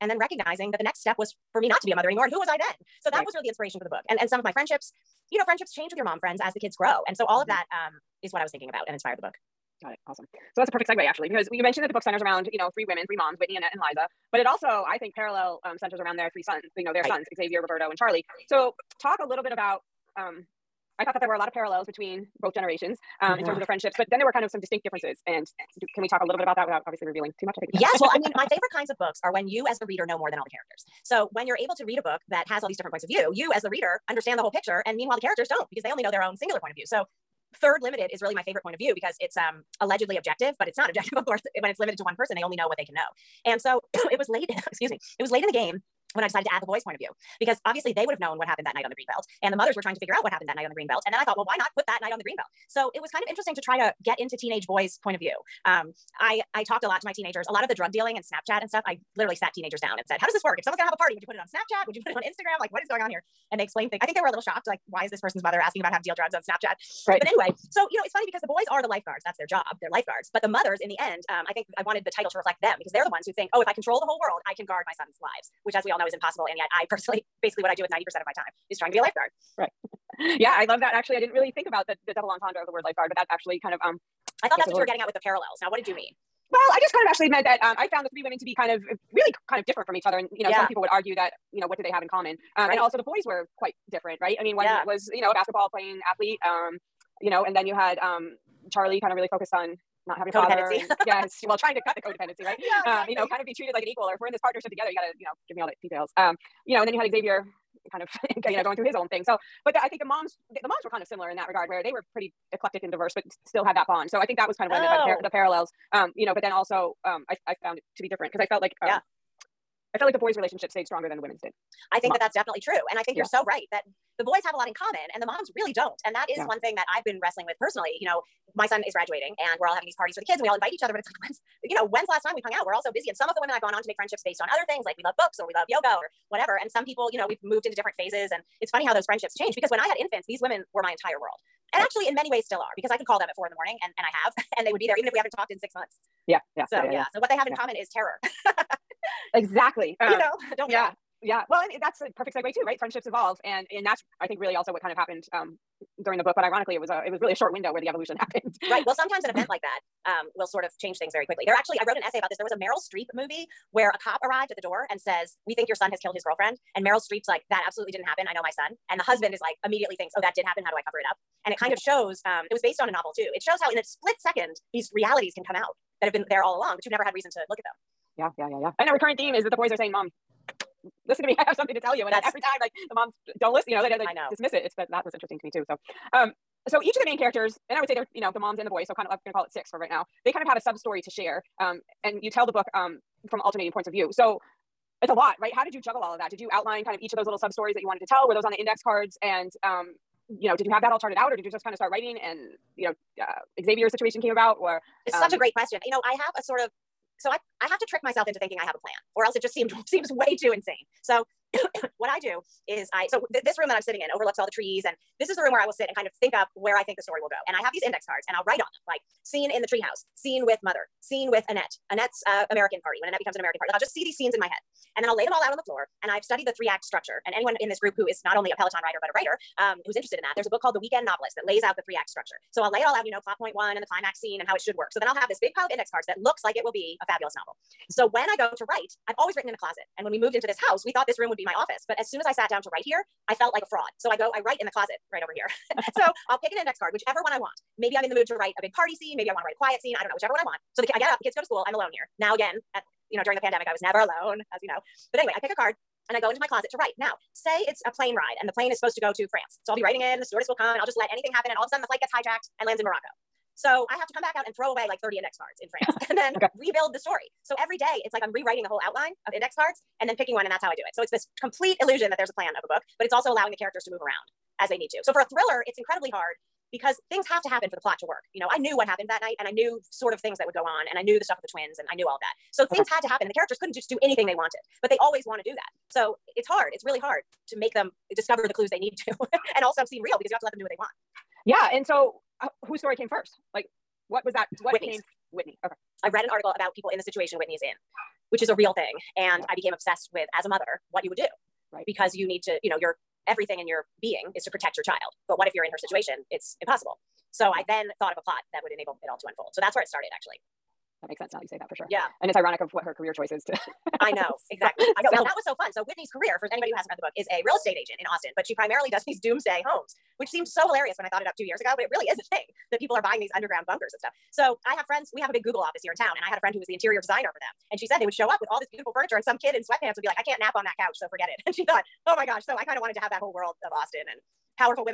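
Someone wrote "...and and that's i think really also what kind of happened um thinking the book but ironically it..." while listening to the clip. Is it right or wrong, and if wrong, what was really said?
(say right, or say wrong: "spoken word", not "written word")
wrong: "during", not "thinking".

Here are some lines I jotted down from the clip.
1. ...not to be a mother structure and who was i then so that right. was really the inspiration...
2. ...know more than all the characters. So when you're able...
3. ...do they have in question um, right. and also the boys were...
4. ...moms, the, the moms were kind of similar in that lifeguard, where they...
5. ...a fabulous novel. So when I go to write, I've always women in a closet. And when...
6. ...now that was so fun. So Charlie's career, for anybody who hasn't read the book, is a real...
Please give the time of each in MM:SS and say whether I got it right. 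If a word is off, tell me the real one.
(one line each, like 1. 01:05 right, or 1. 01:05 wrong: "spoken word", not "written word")
1. 00:01 wrong: "anymore", not "structure"
2. 00:30 right
3. 01:31 wrong: "common", not "question"
4. 01:50 wrong: "regard", not "lifeguard"
5. 03:57 wrong: "written", not "women"
6. 05:15 wrong: "Whitney", not "Charlie".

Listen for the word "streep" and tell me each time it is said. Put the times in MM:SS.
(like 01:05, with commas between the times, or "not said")
02:42, 02:46.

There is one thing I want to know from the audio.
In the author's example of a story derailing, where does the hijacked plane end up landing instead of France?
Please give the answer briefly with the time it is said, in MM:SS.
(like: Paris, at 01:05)
Morocco, at 04:22.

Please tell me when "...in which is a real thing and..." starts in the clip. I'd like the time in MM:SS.
04:57.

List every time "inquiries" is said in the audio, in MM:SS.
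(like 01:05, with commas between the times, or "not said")
not said.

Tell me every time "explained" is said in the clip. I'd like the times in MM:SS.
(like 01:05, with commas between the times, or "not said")
01:03.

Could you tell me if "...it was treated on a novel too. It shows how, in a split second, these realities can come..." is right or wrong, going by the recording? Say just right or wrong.
wrong.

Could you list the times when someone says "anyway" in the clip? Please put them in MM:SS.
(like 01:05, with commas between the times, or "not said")
01:07, 04:15.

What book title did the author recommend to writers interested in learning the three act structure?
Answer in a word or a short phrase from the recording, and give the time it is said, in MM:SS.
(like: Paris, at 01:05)
The Weekend Novelist, at 03:50.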